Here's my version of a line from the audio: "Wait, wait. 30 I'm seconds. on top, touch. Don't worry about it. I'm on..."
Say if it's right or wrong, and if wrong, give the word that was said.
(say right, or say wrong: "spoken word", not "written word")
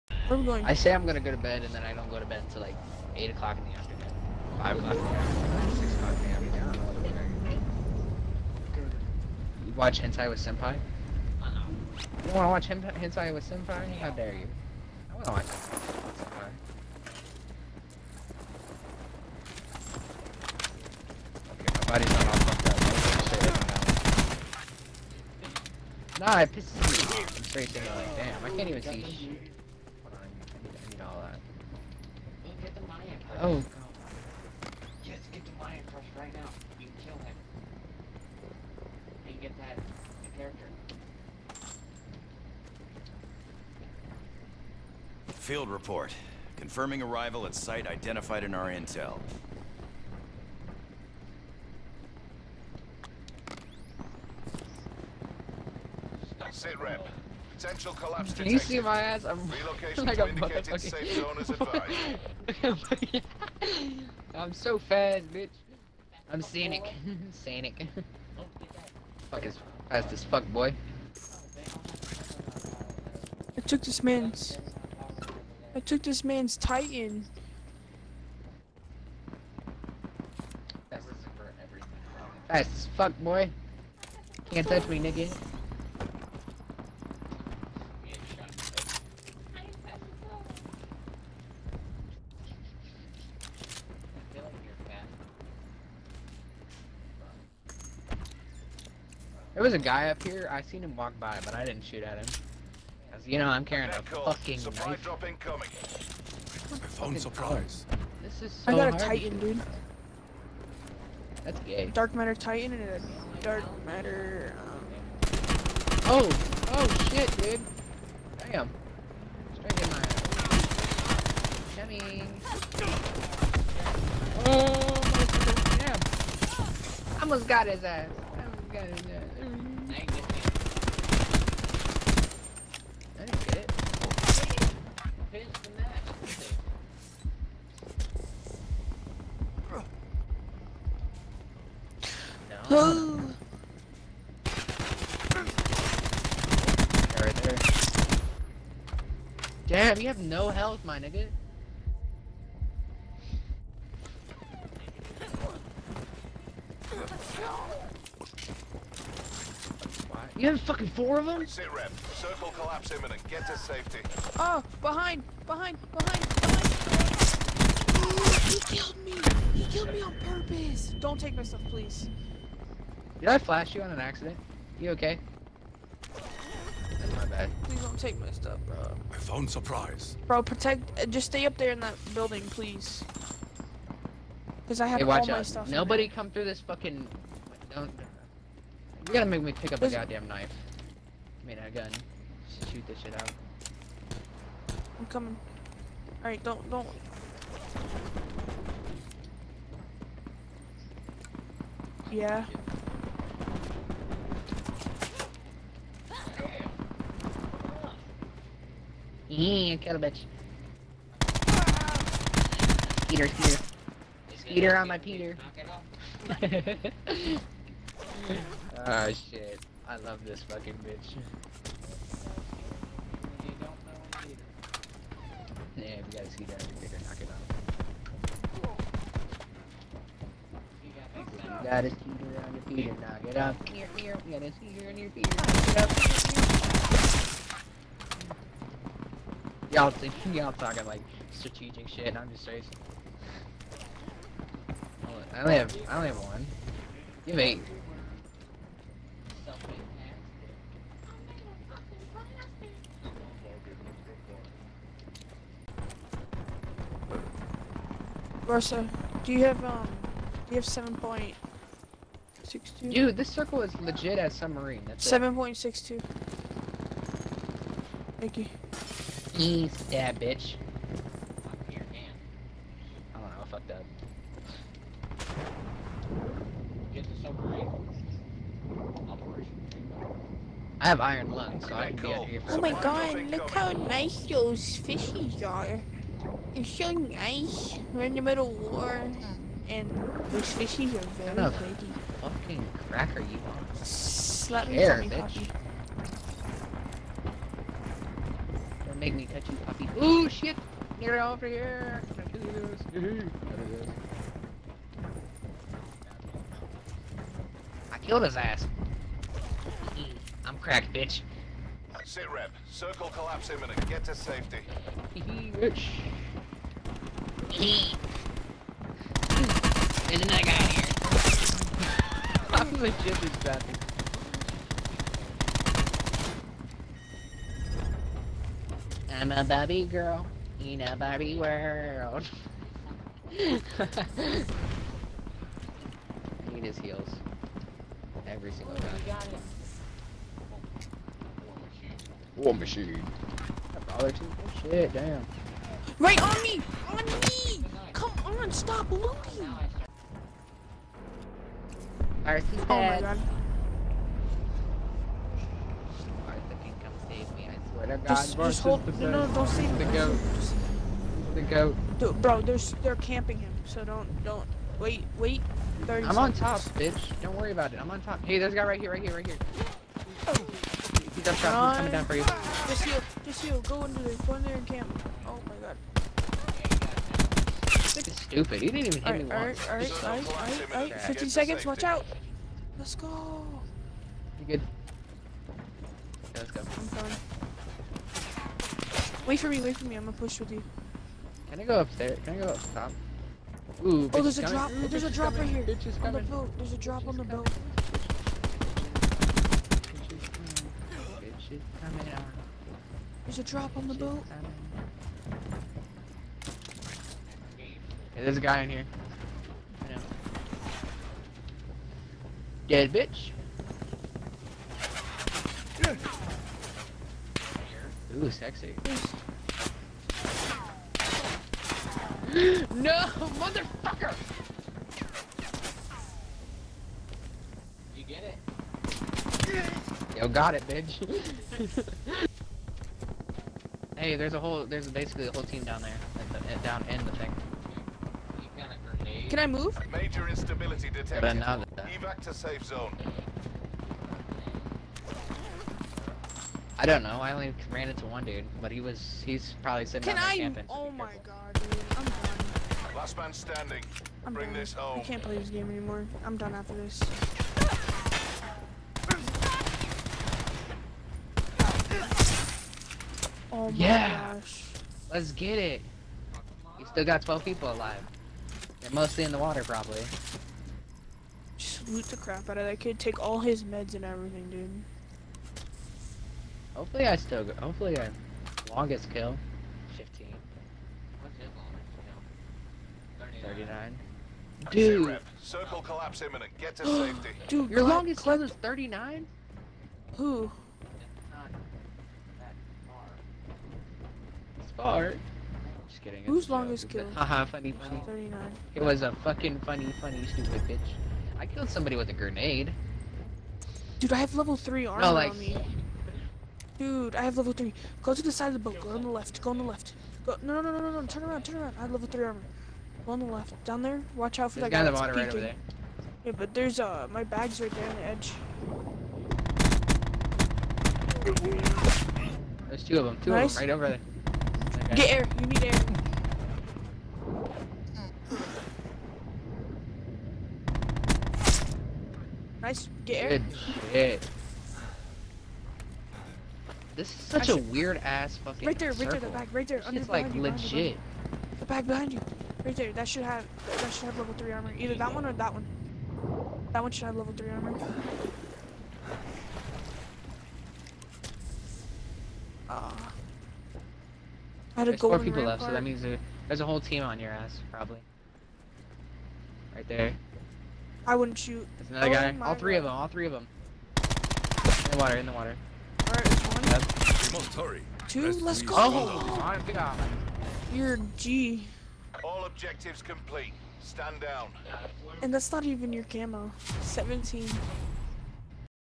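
wrong: "bitch", not "touch".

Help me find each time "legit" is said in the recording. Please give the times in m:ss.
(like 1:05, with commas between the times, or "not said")
4:23, 5:22, 9:00.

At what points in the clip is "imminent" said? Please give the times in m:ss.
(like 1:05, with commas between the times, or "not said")
2:42, 5:13, 8:06.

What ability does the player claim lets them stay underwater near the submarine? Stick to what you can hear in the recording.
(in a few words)
Iron lungs.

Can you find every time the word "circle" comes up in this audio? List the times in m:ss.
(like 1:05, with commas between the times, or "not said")
2:42, 4:23, 5:12, 8:05, 8:58.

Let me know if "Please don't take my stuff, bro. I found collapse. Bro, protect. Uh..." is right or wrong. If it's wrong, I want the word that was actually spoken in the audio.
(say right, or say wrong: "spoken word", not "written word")
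wrong: "surprise", not "collapse".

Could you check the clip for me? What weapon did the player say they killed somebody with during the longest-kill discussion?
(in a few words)
A grenade.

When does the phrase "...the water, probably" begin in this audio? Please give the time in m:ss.
7:49.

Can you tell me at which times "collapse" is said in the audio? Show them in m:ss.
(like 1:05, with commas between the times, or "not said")
0:57, 2:42, 5:13, 8:05.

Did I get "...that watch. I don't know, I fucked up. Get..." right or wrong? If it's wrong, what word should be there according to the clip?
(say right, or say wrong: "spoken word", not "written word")
wrong: "bitch", not "watch".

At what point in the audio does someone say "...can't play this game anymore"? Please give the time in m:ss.
7:35.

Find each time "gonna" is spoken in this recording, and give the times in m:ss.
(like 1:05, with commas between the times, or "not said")
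0:01, 6:30.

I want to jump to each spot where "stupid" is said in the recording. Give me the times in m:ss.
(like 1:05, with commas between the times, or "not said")
6:18, 8:20.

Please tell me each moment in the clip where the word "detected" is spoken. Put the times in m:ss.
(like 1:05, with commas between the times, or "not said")
0:58, 7:20.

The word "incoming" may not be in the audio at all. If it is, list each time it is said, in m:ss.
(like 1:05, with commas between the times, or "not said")
1:45.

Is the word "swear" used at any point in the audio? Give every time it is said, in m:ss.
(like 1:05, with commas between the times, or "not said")
5:57.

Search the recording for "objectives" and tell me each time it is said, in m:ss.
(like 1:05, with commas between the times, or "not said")
9:32.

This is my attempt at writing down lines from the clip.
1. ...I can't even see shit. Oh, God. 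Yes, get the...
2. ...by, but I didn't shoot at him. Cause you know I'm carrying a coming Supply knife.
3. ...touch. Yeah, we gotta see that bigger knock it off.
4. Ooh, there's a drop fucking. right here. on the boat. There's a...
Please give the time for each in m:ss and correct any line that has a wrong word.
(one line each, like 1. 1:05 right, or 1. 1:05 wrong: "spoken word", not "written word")
1. 0:28 right
2. 1:41 wrong: "fucking", not "coming"
3. 3:40 wrong: "bitch", not "touch"
4. 6:34 wrong: "coming", not "fucking".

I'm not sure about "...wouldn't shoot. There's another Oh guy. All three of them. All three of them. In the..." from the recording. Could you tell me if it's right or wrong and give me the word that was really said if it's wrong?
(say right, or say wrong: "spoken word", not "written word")
right.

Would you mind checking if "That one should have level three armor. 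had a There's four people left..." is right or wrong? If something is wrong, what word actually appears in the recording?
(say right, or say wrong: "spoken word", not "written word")
right.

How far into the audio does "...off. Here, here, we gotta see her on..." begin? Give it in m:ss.
3:53.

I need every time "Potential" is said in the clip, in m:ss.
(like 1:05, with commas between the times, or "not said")
0:57.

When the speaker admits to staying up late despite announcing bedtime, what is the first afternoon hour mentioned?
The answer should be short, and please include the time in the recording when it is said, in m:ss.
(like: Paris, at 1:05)
8 o'clock, at 0:03.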